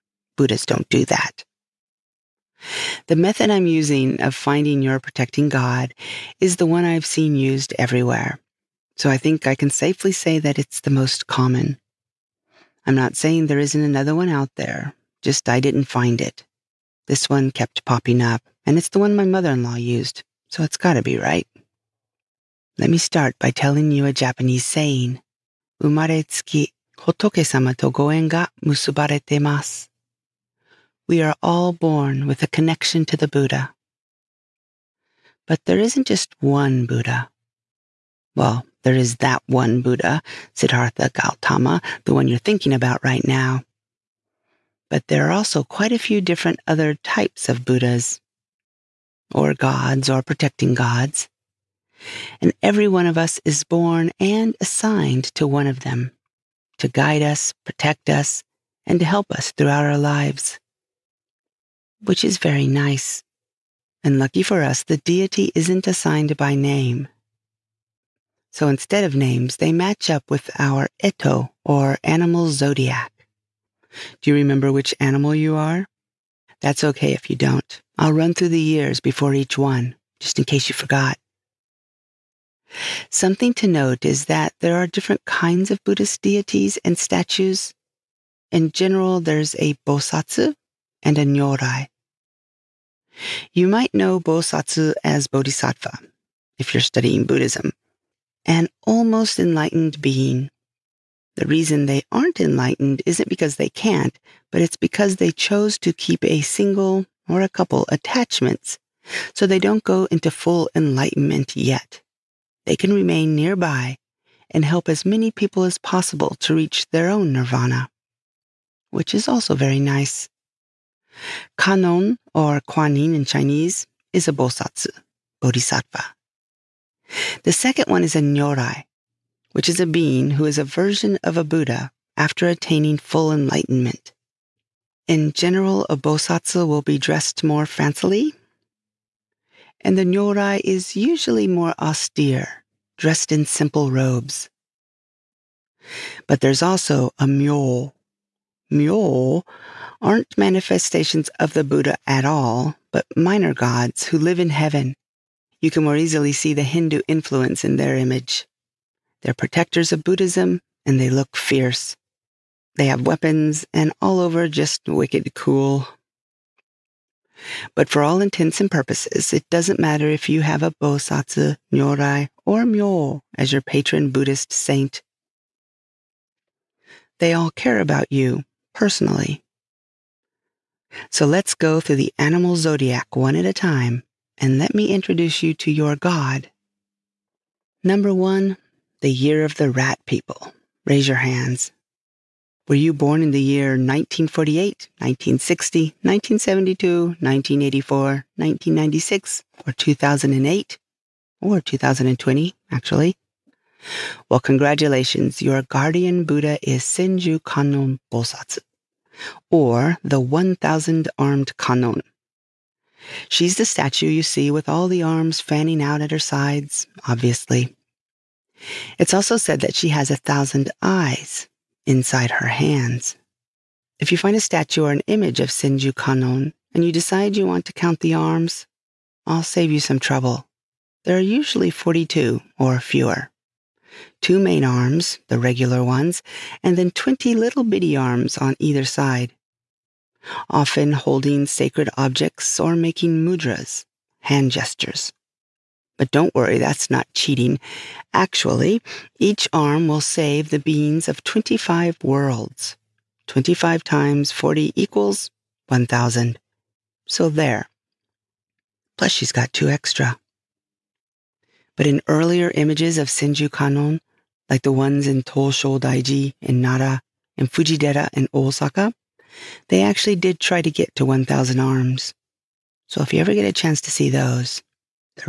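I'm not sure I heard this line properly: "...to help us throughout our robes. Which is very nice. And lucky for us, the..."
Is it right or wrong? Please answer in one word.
wrong.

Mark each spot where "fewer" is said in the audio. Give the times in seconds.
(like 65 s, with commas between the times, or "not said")
232 s.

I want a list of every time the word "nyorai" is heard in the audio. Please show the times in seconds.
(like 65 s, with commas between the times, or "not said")
91 s, 128 s, 140 s, 171 s.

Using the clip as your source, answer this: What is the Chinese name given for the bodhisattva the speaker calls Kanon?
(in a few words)
Kuan Yin.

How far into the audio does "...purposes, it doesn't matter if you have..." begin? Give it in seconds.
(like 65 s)
168 s.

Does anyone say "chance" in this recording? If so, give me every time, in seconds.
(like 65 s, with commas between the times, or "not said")
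273 s.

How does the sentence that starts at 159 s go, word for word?
They're protectors of Buddhism and they look fierce.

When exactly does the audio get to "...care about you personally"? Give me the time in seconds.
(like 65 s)
177 s.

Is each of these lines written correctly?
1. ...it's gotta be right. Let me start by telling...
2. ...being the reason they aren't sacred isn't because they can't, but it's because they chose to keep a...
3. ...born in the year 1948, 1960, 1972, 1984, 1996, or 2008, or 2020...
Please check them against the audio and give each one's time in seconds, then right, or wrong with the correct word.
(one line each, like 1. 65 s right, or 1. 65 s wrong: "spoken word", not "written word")
1. 20 s right
2. 100 s wrong: "enlightened", not "sacred"
3. 192 s right.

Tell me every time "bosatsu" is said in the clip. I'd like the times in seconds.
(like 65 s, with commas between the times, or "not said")
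89 s, 94 s, 124 s, 135 s, 170 s, 208 s.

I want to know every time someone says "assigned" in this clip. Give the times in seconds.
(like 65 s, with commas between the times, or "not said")
54 s, 65 s.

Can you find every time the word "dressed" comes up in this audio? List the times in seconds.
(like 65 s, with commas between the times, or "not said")
136 s, 142 s.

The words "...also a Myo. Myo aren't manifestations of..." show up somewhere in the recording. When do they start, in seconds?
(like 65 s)
146 s.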